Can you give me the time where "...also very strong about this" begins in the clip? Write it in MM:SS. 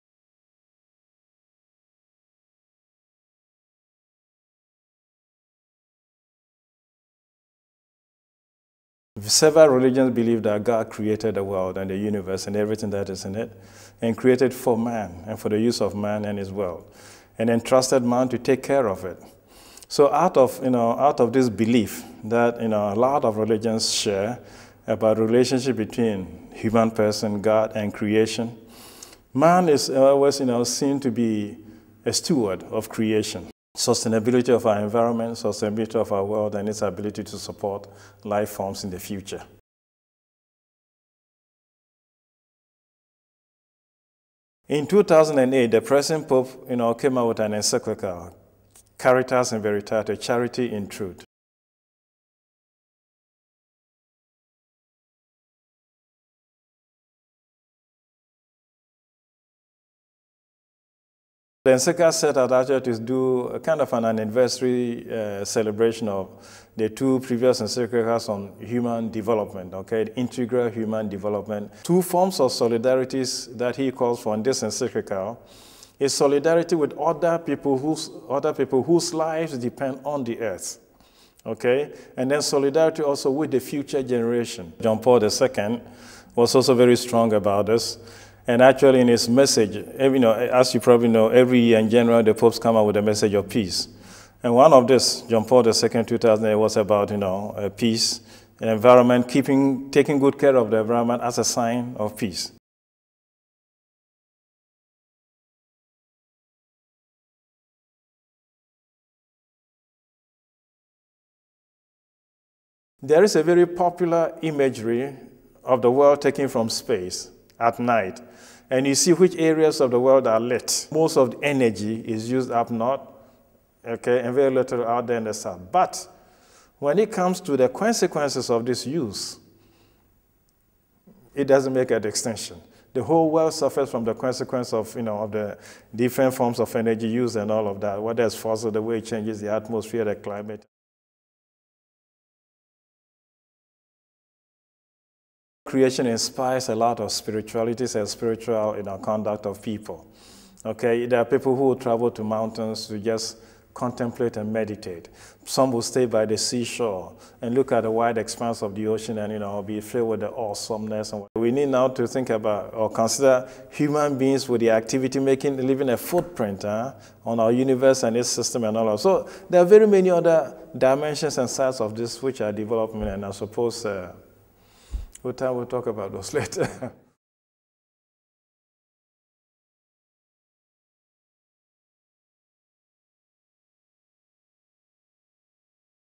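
01:26.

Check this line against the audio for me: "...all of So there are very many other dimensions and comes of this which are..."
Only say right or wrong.
wrong.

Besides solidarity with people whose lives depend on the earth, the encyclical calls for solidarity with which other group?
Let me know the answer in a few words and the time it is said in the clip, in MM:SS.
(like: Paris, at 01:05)
the future generation, at 01:23.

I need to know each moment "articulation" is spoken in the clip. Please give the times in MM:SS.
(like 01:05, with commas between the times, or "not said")
not said.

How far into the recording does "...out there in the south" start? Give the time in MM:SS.
02:04.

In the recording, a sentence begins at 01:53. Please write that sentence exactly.
There is a very popular imagery of the world taken from space at night.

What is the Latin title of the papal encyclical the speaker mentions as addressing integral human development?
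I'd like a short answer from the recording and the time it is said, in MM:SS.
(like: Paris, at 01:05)
Caritas in Veritate, at 00:48.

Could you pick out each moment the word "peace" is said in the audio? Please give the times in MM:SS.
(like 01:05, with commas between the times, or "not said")
01:33, 01:37, 01:42.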